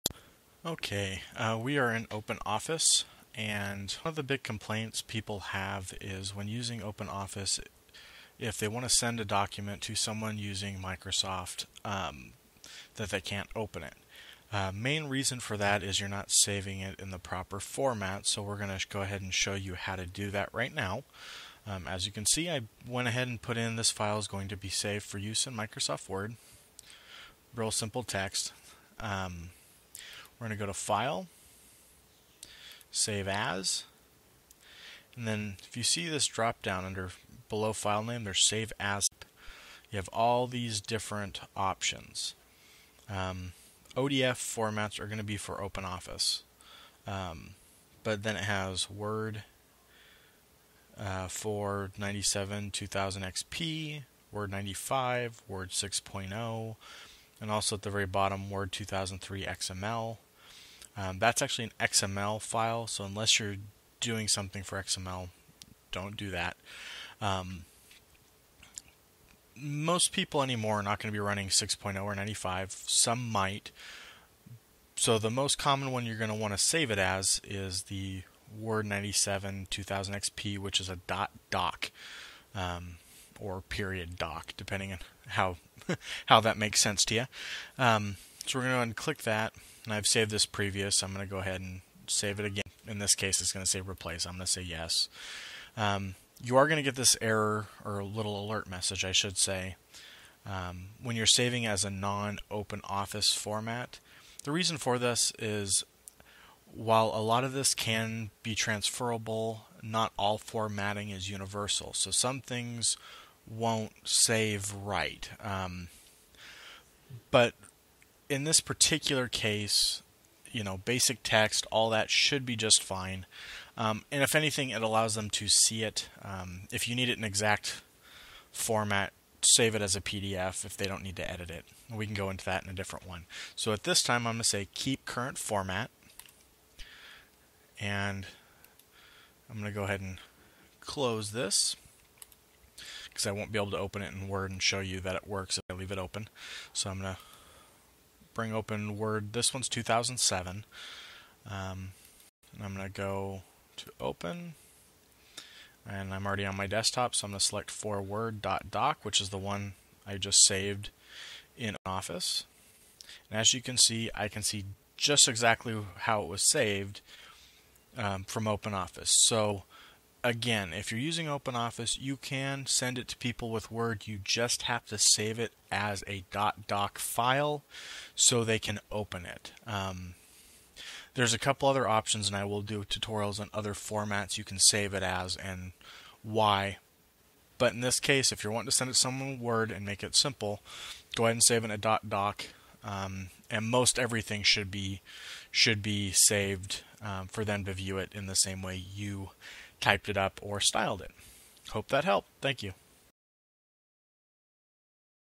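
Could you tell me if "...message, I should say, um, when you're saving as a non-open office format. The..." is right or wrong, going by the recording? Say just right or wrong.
right.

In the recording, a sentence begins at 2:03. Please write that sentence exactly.
Um, and if anything, it allows them to see it.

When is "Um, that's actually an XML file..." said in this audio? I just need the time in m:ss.
1:00.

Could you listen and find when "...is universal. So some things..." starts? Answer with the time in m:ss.
1:51.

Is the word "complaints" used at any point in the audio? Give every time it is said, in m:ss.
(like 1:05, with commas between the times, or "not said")
0:04.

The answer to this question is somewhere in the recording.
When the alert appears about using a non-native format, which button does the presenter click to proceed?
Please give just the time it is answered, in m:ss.
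2:14.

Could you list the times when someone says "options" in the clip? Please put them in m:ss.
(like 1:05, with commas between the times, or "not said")
0:41, 3:01.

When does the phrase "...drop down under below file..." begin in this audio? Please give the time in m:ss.
0:36.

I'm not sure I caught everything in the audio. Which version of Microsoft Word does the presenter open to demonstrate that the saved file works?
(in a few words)
2007.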